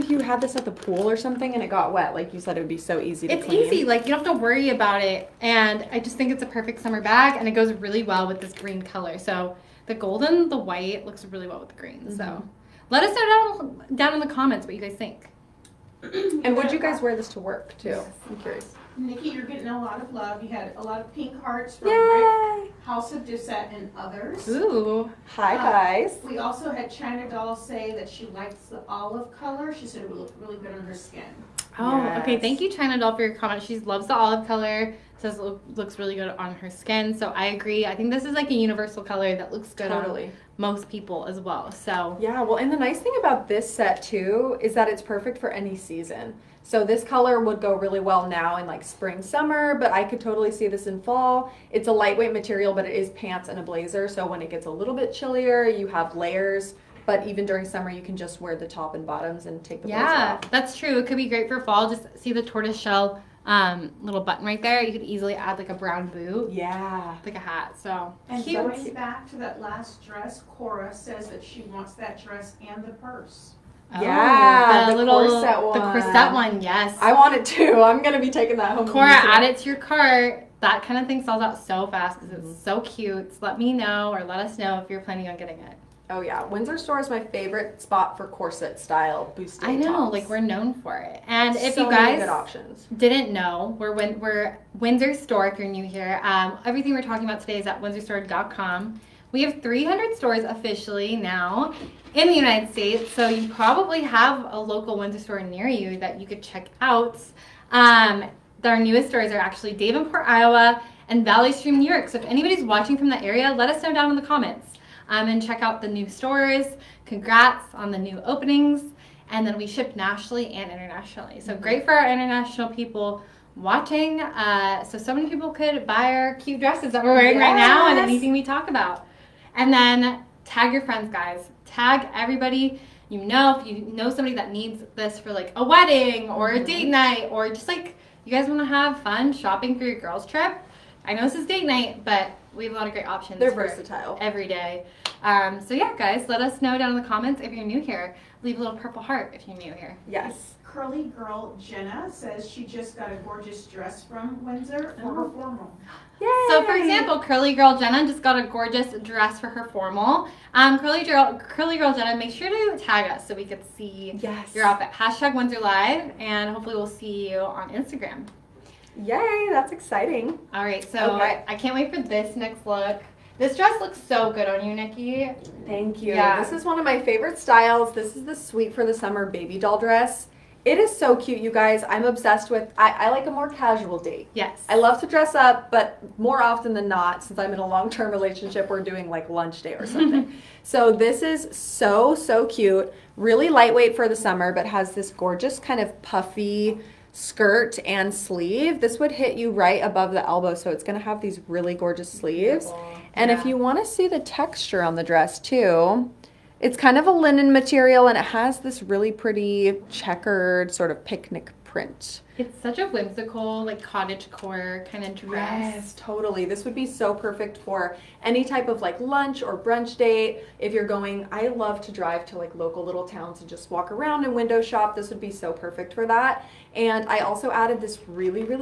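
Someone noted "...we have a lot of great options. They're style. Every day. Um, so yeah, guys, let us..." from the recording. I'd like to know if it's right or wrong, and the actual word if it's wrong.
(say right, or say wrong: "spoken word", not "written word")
wrong: "versatile", not "style".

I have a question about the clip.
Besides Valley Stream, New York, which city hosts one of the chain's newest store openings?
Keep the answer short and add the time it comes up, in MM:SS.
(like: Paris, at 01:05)
Davenport, Iowa, at 01:49.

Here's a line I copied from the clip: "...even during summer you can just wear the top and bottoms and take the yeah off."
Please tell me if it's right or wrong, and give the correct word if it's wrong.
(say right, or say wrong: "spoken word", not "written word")
right.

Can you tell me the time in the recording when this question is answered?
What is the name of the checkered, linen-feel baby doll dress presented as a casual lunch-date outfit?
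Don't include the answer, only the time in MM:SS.
02:58.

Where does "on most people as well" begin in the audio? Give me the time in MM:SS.
00:40.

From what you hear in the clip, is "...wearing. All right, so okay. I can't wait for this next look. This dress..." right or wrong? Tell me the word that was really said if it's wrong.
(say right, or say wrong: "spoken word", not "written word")
wrong: "exciting", not "wearing".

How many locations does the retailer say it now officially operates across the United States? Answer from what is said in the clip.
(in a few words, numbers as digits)
300.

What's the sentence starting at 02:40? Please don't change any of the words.
Um, Curly Girl, Curly Girl Jenna, make sure to tag us so we could see yes.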